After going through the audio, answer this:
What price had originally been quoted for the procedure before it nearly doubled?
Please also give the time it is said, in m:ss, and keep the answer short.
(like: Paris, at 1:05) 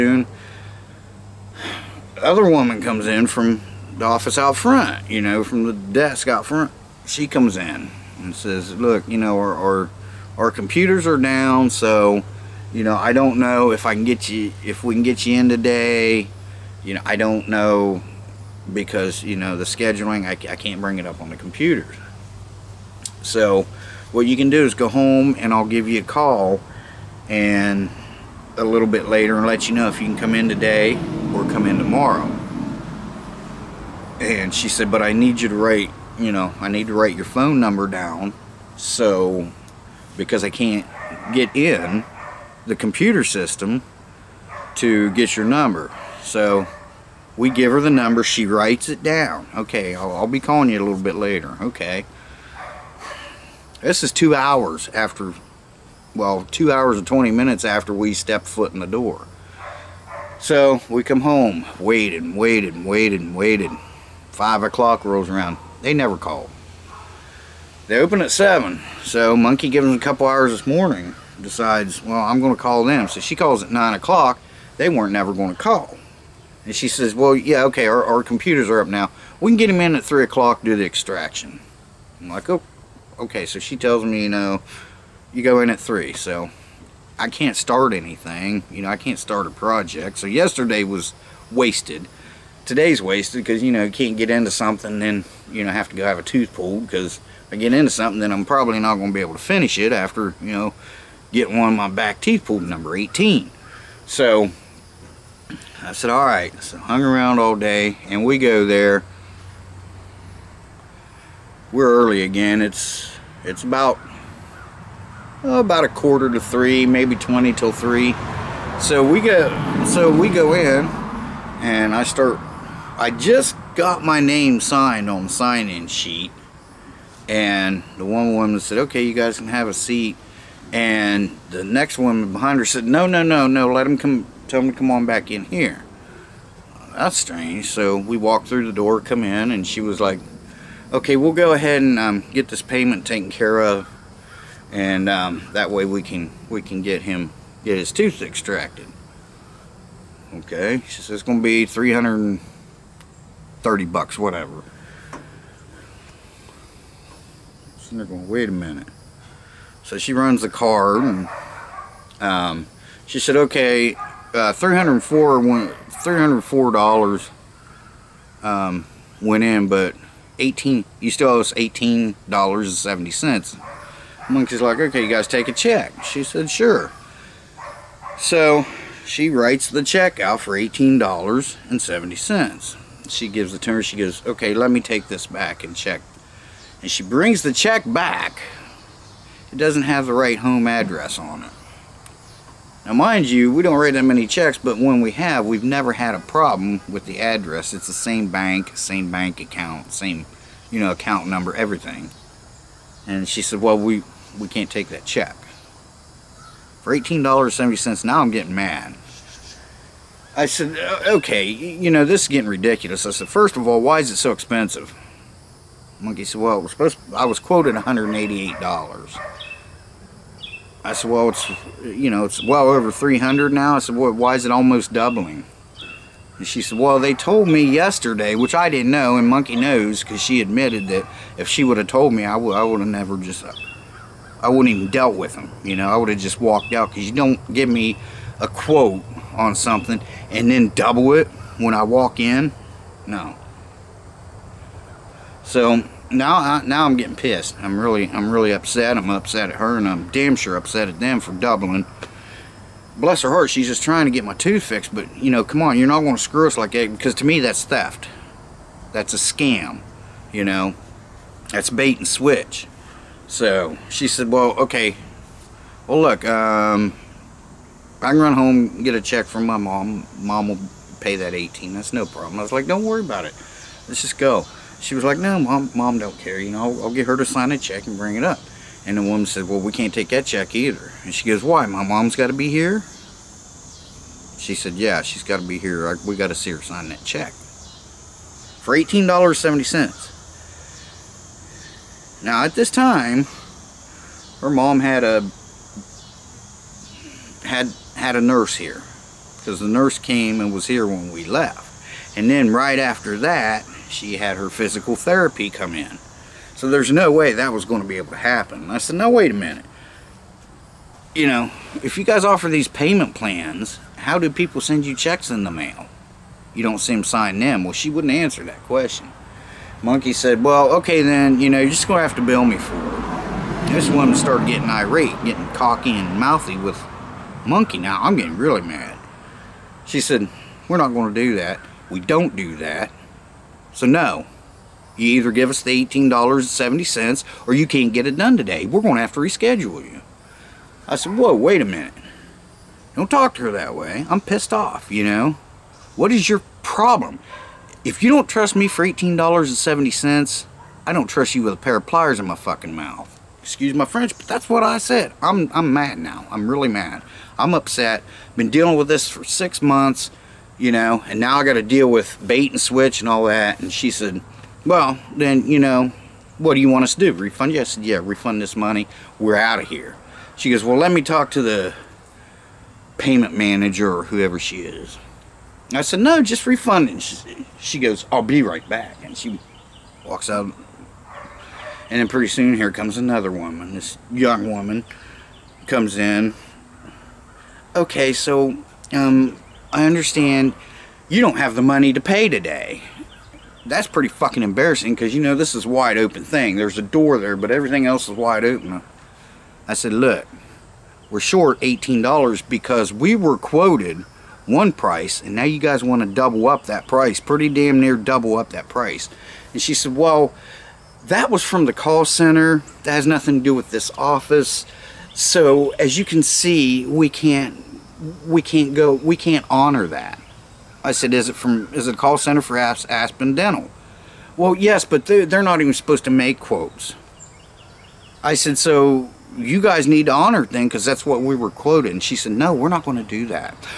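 $188, at 3:37.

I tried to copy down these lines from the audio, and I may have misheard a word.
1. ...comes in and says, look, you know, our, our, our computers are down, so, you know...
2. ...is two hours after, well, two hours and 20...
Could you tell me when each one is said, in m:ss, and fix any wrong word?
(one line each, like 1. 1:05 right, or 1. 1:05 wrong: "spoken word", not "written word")
1. 0:07 right
2. 0:54 right.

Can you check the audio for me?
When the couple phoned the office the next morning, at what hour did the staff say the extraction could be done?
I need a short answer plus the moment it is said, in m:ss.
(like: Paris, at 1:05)
3 o'clock, at 1:20.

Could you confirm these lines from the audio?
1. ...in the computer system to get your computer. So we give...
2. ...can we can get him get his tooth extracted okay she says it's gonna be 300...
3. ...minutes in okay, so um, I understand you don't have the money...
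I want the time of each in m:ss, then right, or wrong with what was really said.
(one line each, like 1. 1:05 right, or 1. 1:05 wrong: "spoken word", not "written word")
1. 0:41 wrong: "number", not "computer"
2. 2:26 right
3. 6:25 wrong: "comes", not "minutes".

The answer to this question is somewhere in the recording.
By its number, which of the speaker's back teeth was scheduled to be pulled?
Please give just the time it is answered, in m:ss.
1:42.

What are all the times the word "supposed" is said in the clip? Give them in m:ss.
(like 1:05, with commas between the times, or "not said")
3:36, 7:05.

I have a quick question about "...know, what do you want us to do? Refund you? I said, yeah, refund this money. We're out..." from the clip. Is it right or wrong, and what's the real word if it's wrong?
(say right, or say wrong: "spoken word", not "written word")
right.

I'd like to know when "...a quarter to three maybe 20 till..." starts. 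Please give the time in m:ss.
1:55.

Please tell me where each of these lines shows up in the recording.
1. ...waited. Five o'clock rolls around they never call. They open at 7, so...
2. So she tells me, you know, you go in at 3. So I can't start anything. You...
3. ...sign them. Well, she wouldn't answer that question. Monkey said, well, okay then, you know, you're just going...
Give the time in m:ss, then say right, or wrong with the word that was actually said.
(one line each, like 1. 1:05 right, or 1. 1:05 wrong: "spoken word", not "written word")
1. 1:03 right
2. 1:23 right
3. 5:17 right.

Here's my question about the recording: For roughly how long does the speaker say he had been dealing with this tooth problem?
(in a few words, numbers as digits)
six months.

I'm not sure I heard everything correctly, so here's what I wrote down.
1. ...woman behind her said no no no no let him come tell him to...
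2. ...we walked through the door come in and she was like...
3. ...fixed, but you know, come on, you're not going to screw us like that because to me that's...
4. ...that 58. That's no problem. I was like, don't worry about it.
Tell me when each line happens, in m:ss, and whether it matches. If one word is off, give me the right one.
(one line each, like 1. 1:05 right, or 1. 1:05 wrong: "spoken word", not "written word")
1. 2:11 right
2. 2:17 right
3. 4:14 right
4. 4:31 wrong: "18", not "58".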